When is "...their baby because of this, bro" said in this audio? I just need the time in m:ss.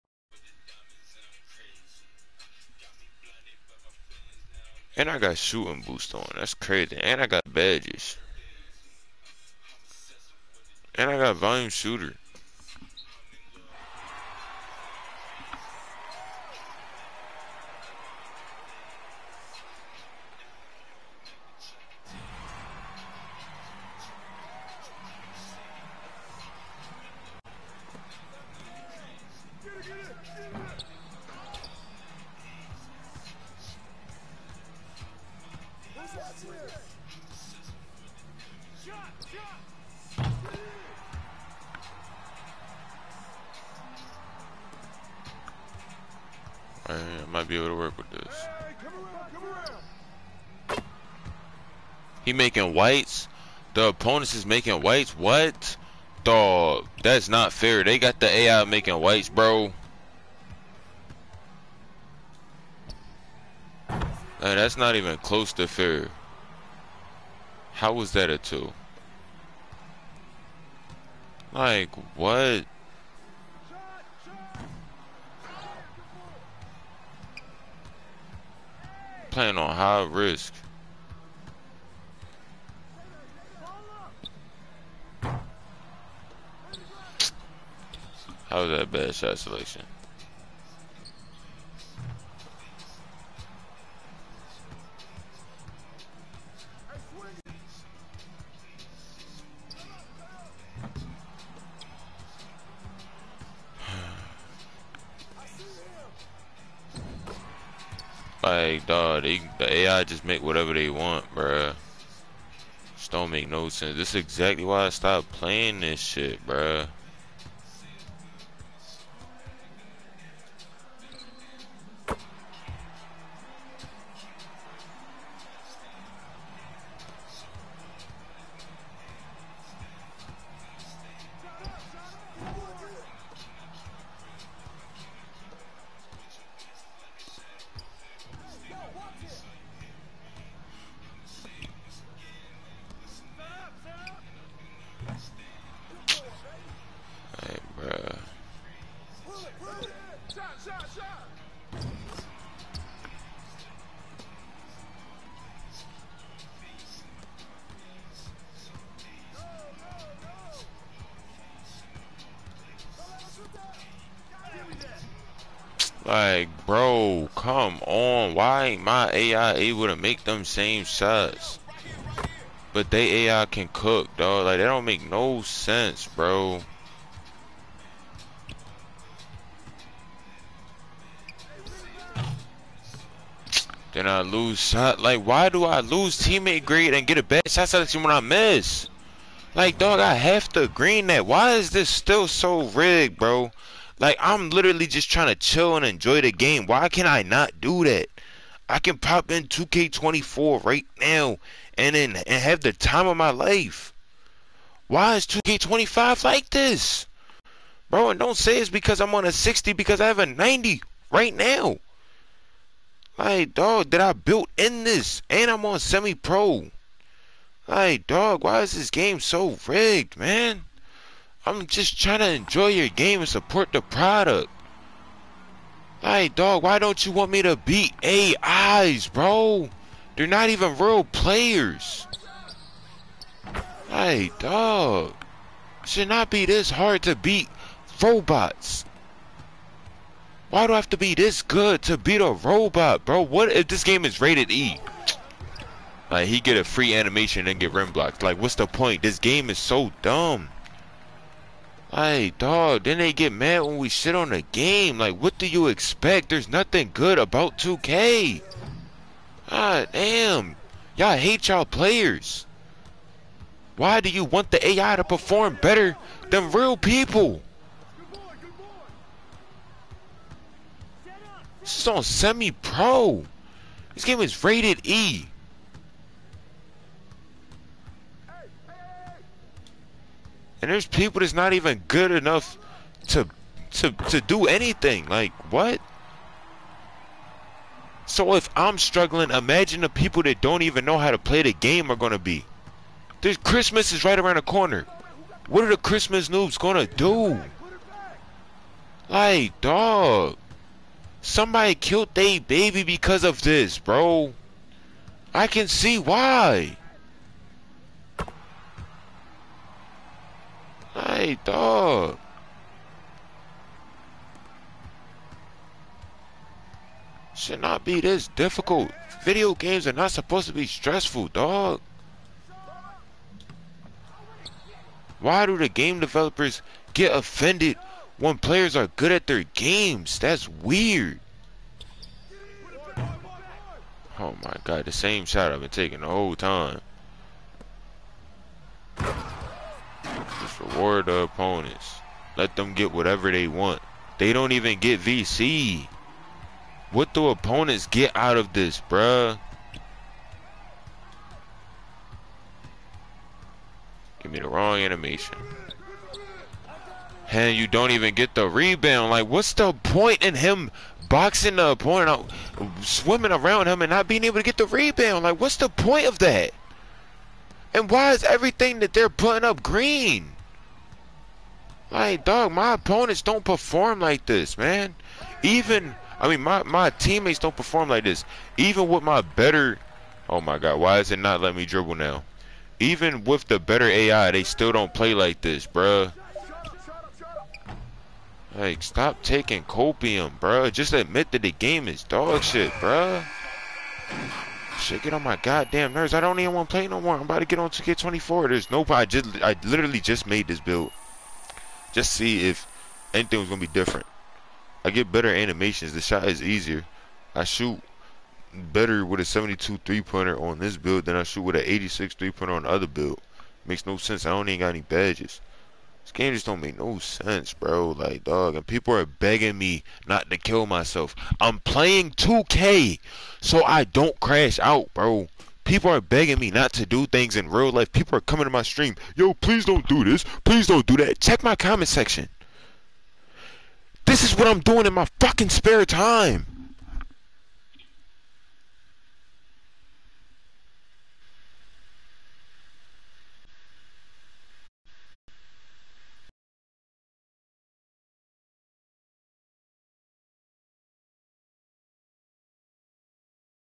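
5:02.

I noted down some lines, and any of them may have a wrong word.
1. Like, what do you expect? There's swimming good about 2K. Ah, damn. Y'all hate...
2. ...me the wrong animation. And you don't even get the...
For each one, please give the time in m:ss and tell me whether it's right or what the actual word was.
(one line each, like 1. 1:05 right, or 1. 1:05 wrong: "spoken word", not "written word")
1. 4:14 wrong: "nothing", not "swimming"
2. 5:54 right.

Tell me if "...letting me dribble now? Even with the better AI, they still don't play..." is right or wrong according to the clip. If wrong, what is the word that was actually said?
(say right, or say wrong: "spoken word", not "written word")
right.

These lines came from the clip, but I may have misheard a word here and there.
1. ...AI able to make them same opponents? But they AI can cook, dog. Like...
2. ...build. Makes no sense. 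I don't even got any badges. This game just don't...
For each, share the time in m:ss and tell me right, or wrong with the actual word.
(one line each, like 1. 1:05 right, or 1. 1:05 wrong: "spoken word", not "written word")
1. 2:49 wrong: "shots", not "opponents"
2. 6:52 right.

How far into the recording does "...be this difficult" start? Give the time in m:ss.
5:17.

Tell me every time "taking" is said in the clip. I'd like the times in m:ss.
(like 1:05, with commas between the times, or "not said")
5:35, 6:29.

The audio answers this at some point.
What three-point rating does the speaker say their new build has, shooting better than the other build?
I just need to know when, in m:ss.
6:49.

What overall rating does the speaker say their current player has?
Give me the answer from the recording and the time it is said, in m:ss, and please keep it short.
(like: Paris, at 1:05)
90, at 3:30.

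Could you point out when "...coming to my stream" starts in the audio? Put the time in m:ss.
7:08.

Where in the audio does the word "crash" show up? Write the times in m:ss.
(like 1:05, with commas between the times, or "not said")
7:04.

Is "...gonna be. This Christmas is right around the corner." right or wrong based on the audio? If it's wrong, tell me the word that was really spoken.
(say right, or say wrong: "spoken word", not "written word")
right.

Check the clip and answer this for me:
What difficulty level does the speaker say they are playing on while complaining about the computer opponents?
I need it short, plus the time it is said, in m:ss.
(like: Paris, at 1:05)
Semi pro, at 3:35.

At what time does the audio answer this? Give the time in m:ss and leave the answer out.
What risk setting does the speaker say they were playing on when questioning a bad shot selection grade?
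1:19.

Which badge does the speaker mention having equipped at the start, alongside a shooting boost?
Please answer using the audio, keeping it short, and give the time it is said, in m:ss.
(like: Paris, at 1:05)
Volume shooter, at 0:11.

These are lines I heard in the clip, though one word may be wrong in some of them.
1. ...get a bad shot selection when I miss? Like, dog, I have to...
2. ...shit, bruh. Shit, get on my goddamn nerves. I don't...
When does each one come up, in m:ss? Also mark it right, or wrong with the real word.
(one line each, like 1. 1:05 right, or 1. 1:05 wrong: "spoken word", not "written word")
1. 3:07 right
2. 6:32 right.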